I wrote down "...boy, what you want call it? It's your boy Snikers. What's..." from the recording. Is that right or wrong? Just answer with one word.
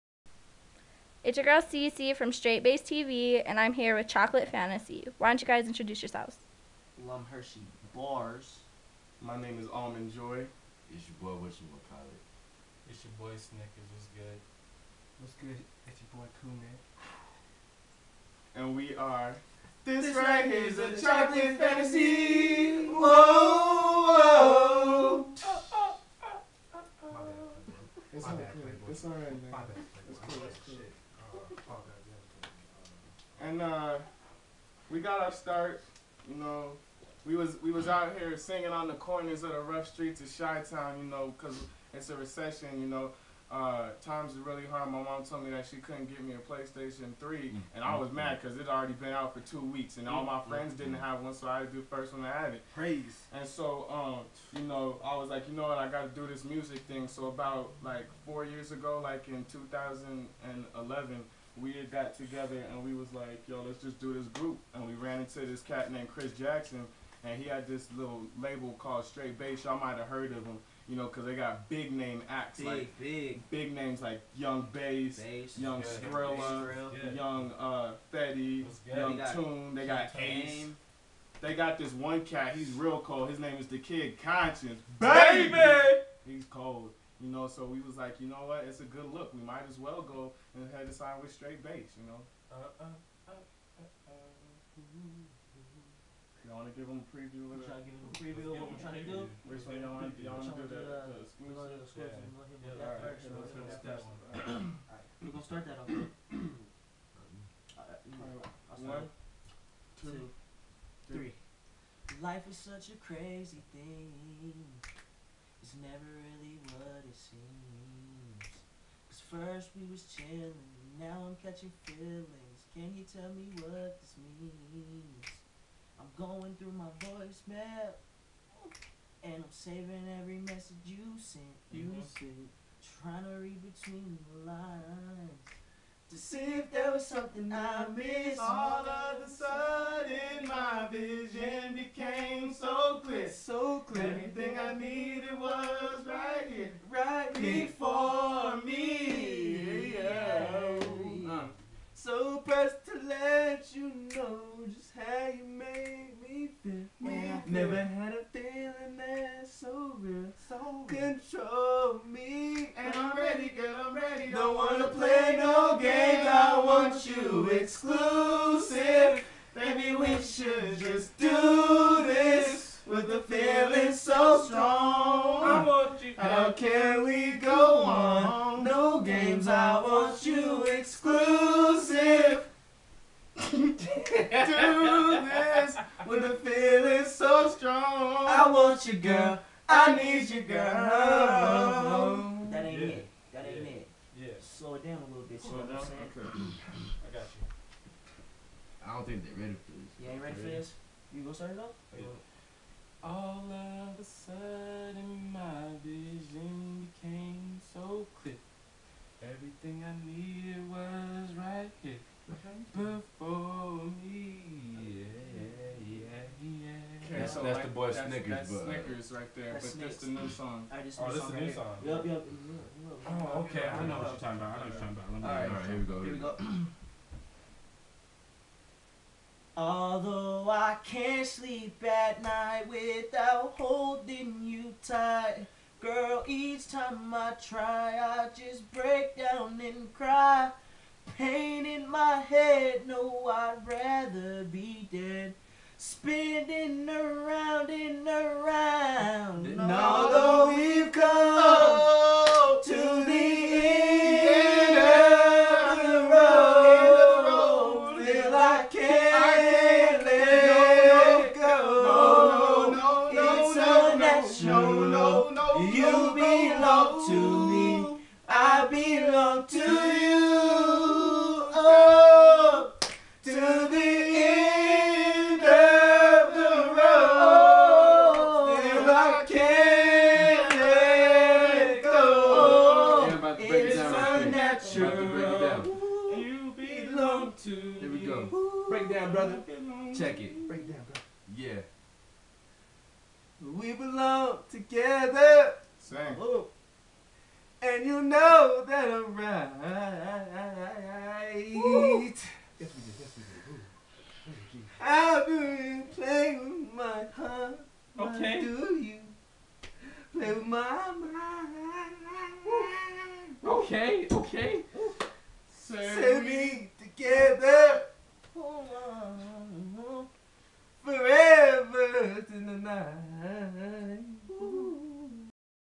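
right.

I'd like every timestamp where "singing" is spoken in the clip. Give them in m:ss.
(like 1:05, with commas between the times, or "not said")
0:38.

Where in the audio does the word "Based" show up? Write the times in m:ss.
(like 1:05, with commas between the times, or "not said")
0:02, 1:09.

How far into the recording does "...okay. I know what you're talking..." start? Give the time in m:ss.
3:43.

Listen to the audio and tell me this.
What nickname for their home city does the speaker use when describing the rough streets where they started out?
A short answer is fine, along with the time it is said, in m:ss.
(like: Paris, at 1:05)
Chi Town, at 0:40.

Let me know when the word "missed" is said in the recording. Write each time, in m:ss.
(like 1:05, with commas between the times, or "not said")
2:18.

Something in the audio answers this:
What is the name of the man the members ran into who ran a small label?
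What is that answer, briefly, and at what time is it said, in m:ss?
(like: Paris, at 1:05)
Chris Jackson, at 1:06.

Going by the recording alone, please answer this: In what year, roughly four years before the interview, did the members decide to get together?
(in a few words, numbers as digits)
2011.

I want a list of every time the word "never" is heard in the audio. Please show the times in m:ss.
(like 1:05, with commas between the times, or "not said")
1:55, 2:37.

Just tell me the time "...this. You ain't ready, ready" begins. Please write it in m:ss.
3:19.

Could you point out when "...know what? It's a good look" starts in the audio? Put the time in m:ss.
1:28.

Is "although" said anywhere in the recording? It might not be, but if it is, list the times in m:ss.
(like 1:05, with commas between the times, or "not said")
3:49, 4:09.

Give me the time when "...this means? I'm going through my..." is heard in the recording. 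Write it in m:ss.
2:04.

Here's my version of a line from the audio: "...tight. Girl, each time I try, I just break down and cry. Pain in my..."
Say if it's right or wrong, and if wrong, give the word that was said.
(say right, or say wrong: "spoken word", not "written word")
right.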